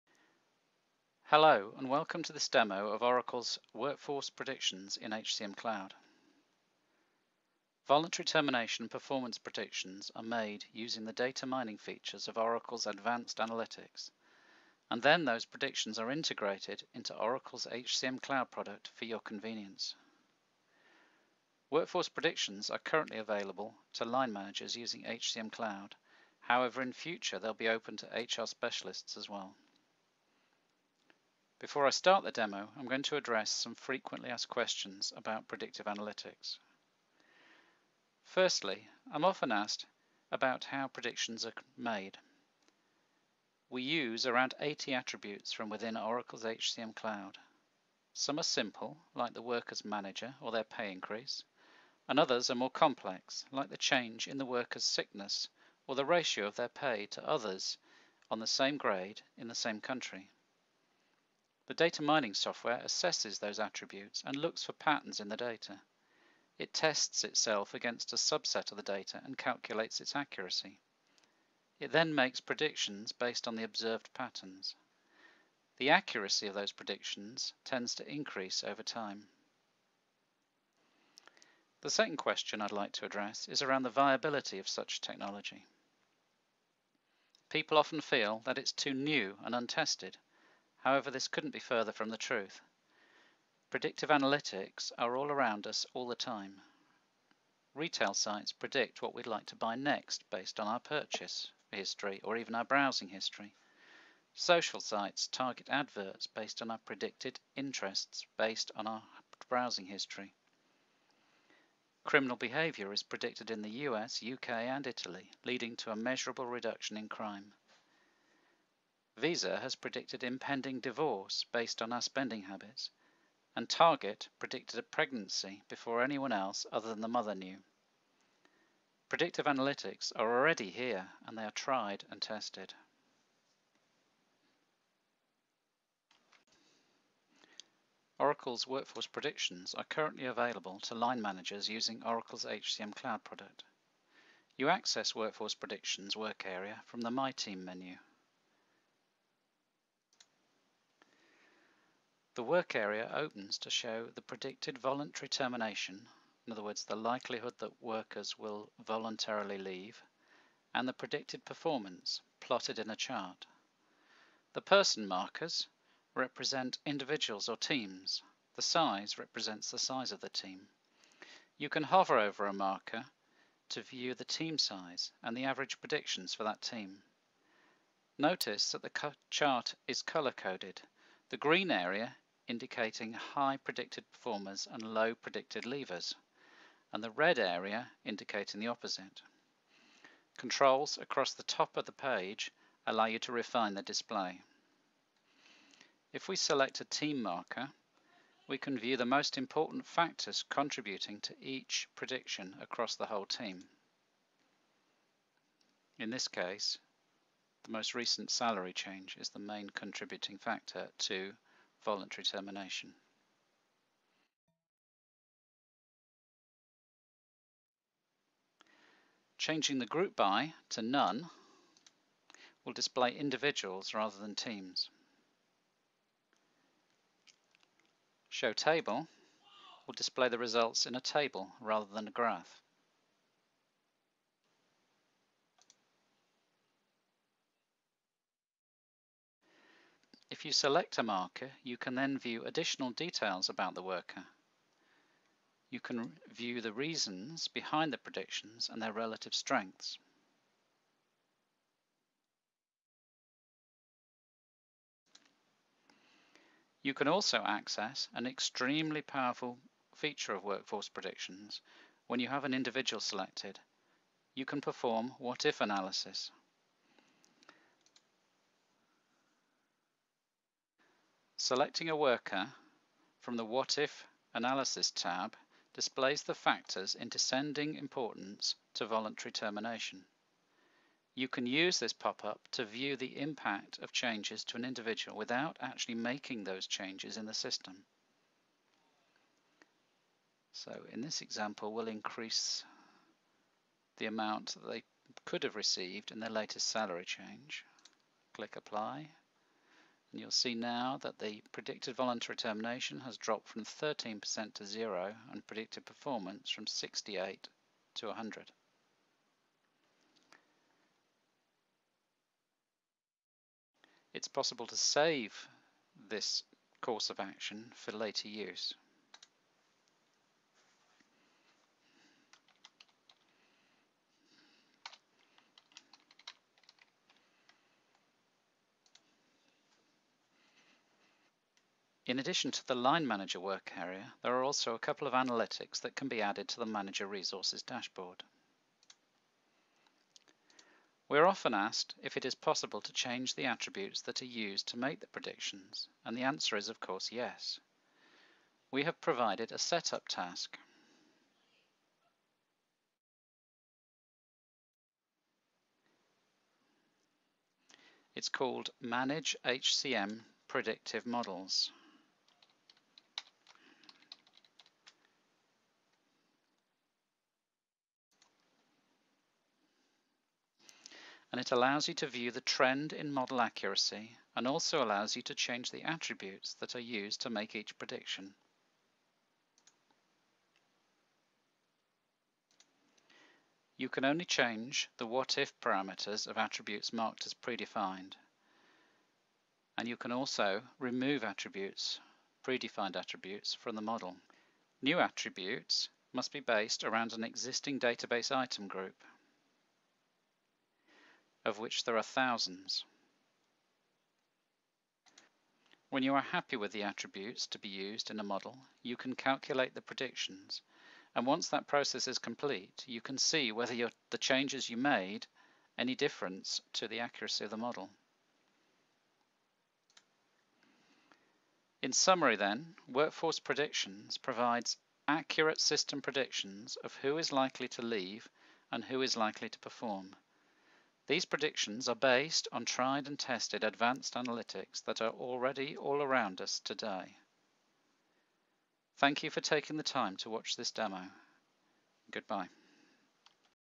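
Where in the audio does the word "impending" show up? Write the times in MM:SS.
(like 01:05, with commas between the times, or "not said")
02:00.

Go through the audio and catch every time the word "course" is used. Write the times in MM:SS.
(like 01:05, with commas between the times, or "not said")
05:16, 05:46.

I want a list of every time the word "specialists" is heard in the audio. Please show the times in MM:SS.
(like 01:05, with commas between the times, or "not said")
00:28.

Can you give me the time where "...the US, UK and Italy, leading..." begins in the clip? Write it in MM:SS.
01:53.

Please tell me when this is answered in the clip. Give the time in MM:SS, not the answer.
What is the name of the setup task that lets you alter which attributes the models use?
05:58.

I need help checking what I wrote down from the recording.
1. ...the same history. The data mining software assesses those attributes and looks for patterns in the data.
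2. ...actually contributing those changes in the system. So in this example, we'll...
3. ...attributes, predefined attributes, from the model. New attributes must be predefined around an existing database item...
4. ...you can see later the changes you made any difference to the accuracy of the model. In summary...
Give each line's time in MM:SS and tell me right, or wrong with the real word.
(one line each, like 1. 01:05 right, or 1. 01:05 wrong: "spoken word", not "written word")
1. 00:59 wrong: "country", not "history"
2. 04:45 wrong: "making", not "contributing"
3. 06:31 wrong: "based", not "predefined"
4. 06:52 wrong: "whether", not "later".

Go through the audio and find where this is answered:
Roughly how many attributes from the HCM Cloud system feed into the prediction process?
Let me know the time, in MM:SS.
00:44.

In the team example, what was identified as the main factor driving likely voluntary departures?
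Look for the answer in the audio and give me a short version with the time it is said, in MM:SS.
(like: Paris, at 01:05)
Most recent salary change, at 03:27.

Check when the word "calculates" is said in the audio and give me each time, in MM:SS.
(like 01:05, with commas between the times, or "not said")
01:09, 06:49.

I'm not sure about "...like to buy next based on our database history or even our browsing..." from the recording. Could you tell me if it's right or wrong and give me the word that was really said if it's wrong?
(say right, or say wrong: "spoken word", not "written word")
wrong: "purchase", not "database".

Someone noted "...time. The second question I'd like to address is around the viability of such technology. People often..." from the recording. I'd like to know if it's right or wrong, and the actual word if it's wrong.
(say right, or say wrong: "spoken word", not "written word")
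right.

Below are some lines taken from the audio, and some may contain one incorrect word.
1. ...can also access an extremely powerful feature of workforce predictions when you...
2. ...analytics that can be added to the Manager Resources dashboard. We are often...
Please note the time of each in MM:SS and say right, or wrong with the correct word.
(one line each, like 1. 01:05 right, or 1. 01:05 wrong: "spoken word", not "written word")
1. 04:16 right
2. 05:35 right.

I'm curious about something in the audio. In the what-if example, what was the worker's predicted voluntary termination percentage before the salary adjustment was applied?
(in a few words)
13%.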